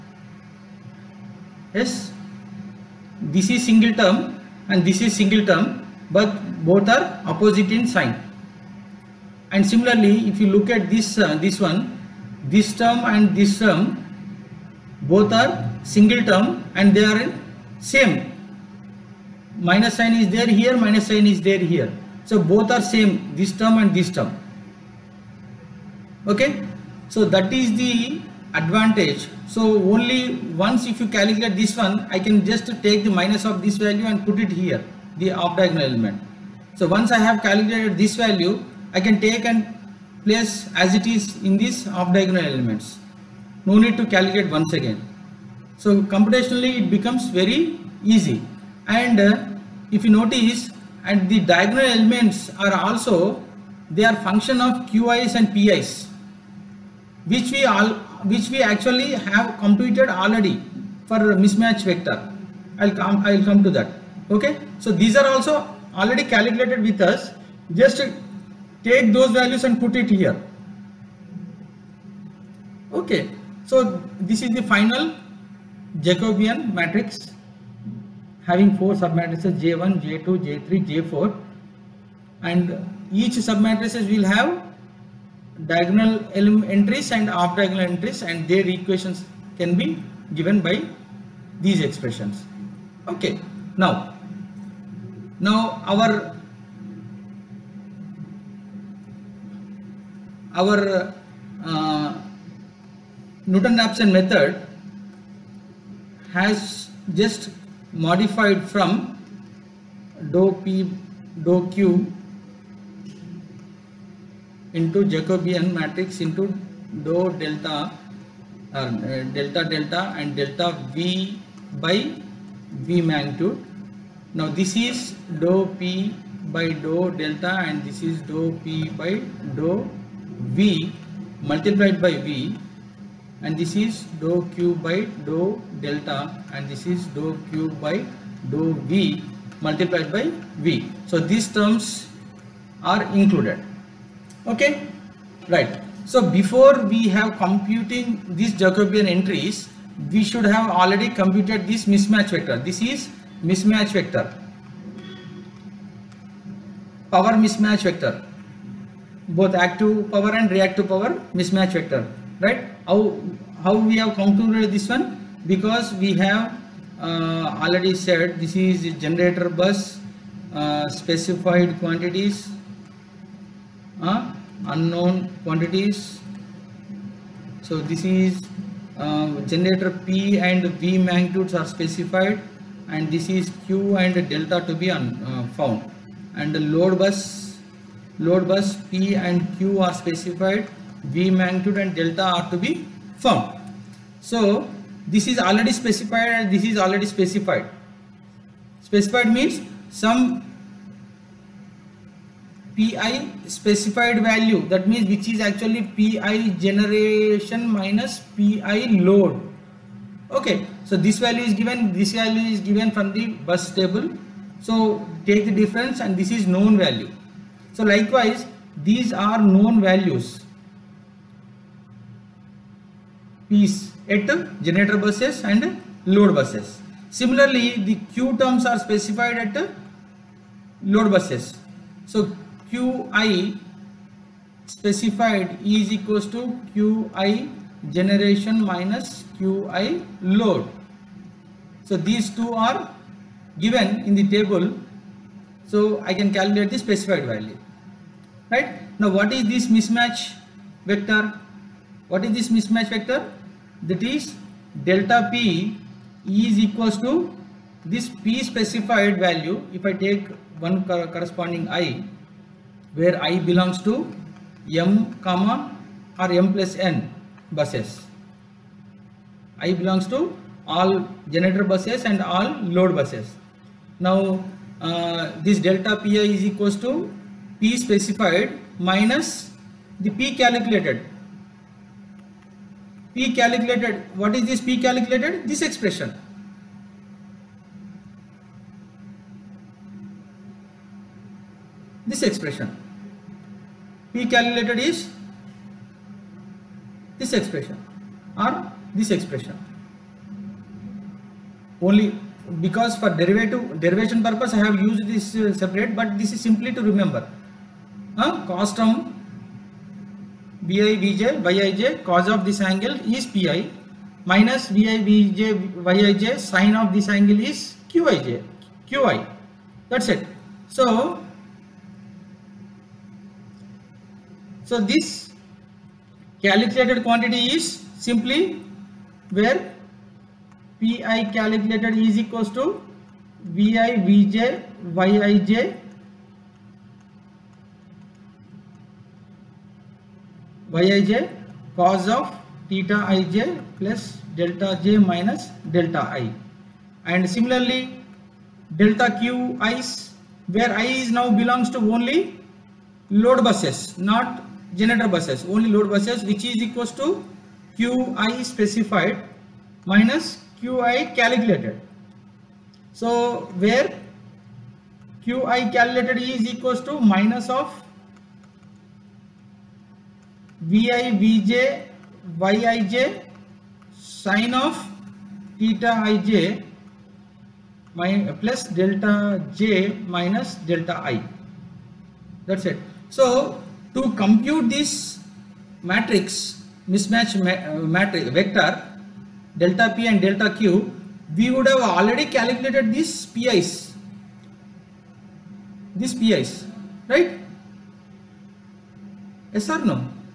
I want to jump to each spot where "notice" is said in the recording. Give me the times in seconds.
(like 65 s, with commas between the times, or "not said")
50 s.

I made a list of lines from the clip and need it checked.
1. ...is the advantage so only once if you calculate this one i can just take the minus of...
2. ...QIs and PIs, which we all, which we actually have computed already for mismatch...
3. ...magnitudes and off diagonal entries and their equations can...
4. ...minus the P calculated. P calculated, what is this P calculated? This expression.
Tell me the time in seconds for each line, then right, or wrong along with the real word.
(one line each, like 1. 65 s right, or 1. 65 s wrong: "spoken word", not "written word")
1. 27 s right
2. 54 s right
3. 86 s wrong: "entries", not "magnitudes"
4. 278 s right.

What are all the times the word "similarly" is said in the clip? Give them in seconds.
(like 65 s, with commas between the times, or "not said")
9 s, 227 s, 347 s.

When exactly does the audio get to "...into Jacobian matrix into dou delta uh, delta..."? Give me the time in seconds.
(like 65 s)
114 s.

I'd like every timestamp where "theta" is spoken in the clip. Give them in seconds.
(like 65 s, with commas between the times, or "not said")
342 s, 375 s.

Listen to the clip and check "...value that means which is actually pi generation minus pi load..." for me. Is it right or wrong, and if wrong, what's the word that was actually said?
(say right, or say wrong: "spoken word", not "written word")
right.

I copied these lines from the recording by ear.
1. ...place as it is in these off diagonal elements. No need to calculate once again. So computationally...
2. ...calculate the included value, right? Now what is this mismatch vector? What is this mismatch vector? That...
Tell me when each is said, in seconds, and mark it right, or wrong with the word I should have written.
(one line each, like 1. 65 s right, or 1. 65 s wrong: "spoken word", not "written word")
1. 40 s right
2. 246 s wrong: "specified", not "included".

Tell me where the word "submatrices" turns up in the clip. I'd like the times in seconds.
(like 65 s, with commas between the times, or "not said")
79 s, 83 s.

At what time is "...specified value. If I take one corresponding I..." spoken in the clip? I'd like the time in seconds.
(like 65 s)
258 s.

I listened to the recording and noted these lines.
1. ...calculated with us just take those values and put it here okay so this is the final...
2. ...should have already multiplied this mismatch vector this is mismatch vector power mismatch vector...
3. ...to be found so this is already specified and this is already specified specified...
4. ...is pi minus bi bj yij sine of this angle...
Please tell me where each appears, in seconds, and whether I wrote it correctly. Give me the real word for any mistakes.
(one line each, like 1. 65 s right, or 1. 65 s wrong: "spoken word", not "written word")
1. 66 s right
2. 150 s wrong: "computed", not "multiplied"
3. 192 s right
4. 313 s right.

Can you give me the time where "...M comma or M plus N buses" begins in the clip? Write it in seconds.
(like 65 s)
264 s.